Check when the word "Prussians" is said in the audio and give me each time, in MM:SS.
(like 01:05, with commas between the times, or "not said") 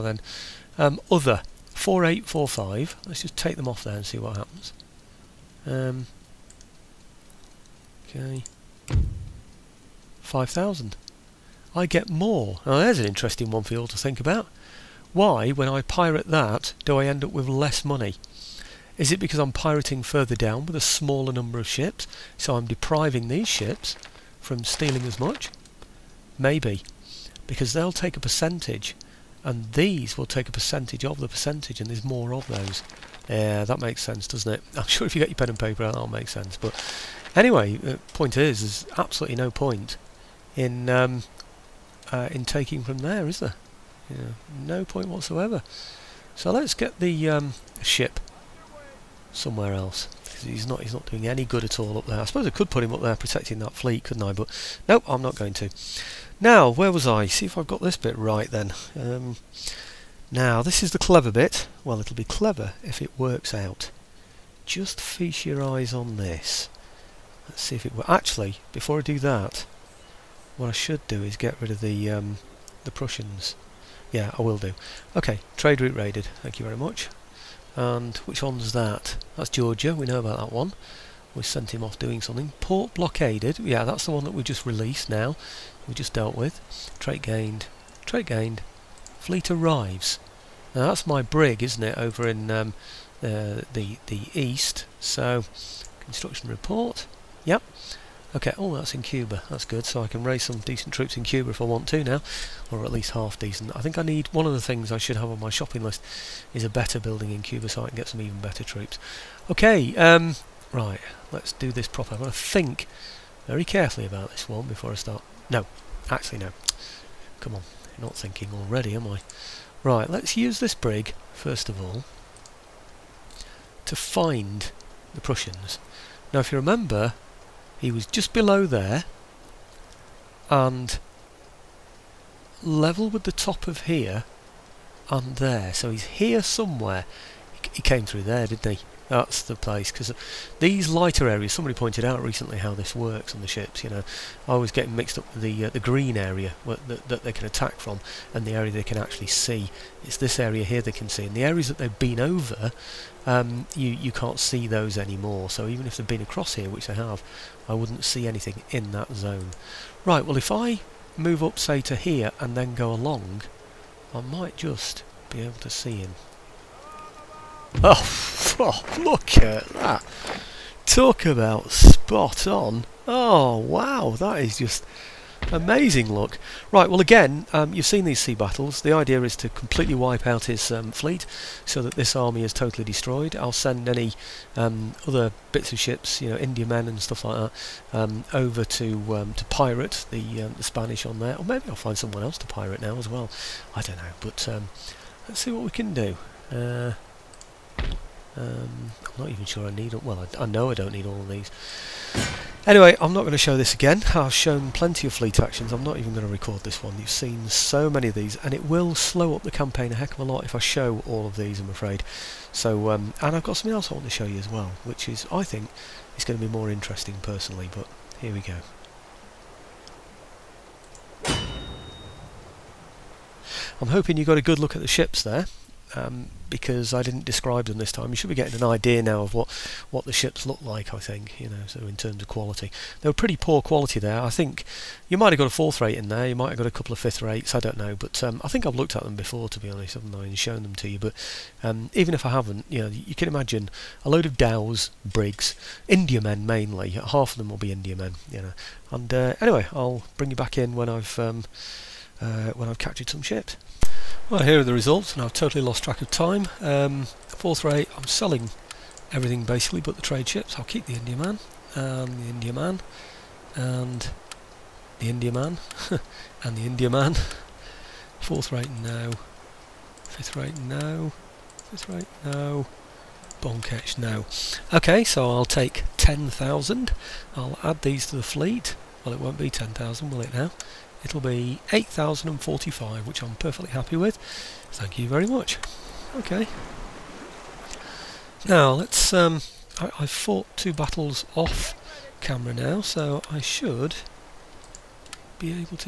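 01:12, 02:05.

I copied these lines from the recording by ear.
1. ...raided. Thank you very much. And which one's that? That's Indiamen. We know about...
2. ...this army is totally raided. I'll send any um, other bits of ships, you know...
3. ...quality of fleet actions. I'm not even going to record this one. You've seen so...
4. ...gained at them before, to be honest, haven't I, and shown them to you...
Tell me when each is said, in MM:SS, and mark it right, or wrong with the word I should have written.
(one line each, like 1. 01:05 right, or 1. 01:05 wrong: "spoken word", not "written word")
1. 01:15 wrong: "Georgia", not "Indiamen"
2. 03:01 wrong: "destroyed", not "raided"
3. 03:24 wrong: "plenty", not "quality"
4. 03:58 wrong: "looked", not "gained".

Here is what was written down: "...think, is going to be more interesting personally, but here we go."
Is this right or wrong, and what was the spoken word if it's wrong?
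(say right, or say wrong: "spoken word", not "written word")
right.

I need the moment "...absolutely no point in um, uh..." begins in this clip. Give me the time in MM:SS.
00:38.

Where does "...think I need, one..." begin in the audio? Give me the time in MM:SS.
01:43.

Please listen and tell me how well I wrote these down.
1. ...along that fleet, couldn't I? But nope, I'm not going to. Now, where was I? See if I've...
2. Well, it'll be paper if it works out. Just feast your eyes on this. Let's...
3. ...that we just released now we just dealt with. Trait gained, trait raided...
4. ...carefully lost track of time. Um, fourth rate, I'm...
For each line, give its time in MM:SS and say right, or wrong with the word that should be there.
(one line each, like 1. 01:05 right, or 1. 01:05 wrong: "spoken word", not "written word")
1. 00:53 wrong: "protecting", not "along"
2. 01:01 wrong: "clever", not "paper"
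3. 01:24 wrong: "gained", not "raided"
4. 04:15 wrong: "totally", not "carefully".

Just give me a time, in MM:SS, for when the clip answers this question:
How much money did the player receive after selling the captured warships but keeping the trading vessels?
04:41.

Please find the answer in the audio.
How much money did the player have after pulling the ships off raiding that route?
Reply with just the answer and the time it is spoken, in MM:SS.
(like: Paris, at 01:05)
5,000, at 00:10.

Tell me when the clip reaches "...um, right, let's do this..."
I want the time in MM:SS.
01:49.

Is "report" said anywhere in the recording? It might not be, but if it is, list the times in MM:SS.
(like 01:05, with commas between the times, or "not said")
01:36.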